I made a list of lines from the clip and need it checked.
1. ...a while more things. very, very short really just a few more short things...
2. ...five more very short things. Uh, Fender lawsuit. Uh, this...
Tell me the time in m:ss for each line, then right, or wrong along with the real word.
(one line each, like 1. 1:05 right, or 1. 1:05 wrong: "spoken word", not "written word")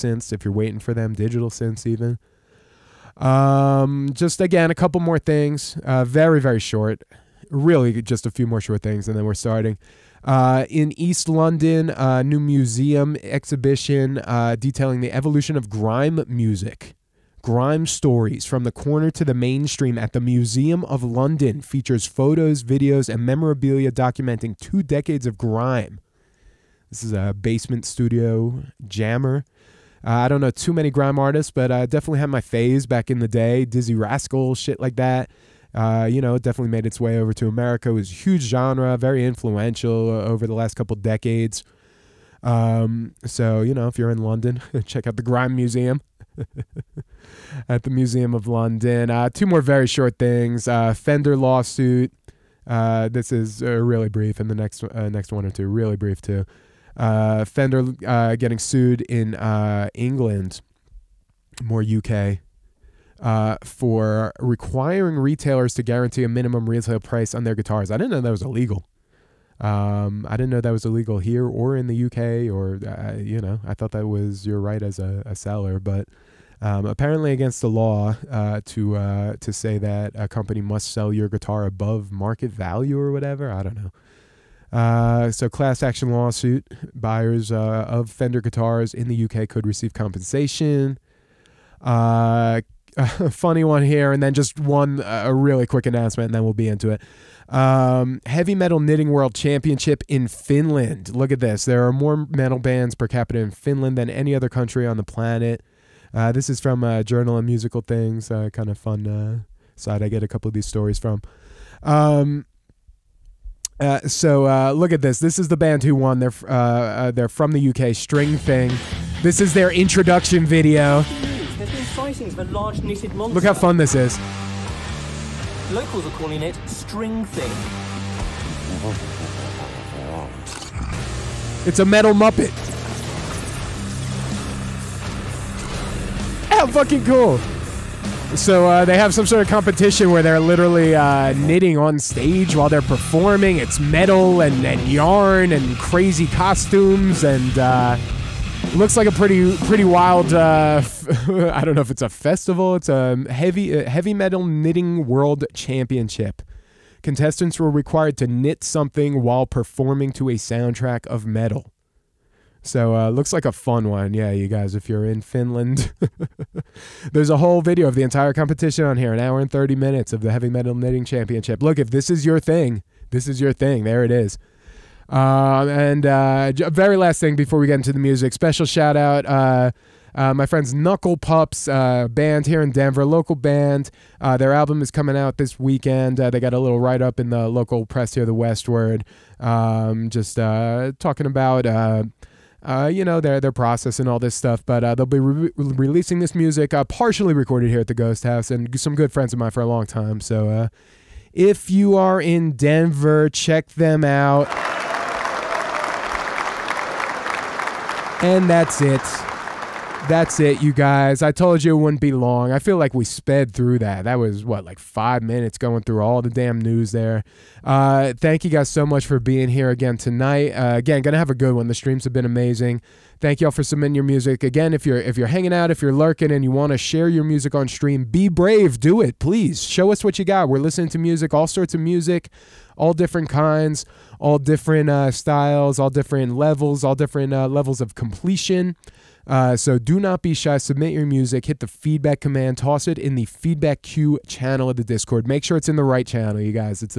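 1. 0:04 wrong: "couple", not "while"
2. 0:49 wrong: "two", not "five".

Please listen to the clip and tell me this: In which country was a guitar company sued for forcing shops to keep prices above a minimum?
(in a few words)
England.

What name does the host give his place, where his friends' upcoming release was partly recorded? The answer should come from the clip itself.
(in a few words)
the Ghost House.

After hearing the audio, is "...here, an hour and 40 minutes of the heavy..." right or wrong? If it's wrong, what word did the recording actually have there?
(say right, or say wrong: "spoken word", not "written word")
wrong: "30", not "40".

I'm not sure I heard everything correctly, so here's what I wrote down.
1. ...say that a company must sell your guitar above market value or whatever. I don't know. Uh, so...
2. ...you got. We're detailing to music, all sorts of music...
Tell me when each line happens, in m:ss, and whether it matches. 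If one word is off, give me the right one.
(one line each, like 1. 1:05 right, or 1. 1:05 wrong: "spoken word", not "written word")
1. 1:19 right
2. 3:50 wrong: "listening", not "detailing".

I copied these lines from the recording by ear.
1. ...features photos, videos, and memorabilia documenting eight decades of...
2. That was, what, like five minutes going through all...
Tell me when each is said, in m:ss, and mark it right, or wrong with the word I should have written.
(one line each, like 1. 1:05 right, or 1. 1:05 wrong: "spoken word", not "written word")
1. 0:21 wrong: "two", not "eight"
2. 3:34 right.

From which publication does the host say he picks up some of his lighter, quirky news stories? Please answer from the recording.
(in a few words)
Journal of Musical Things.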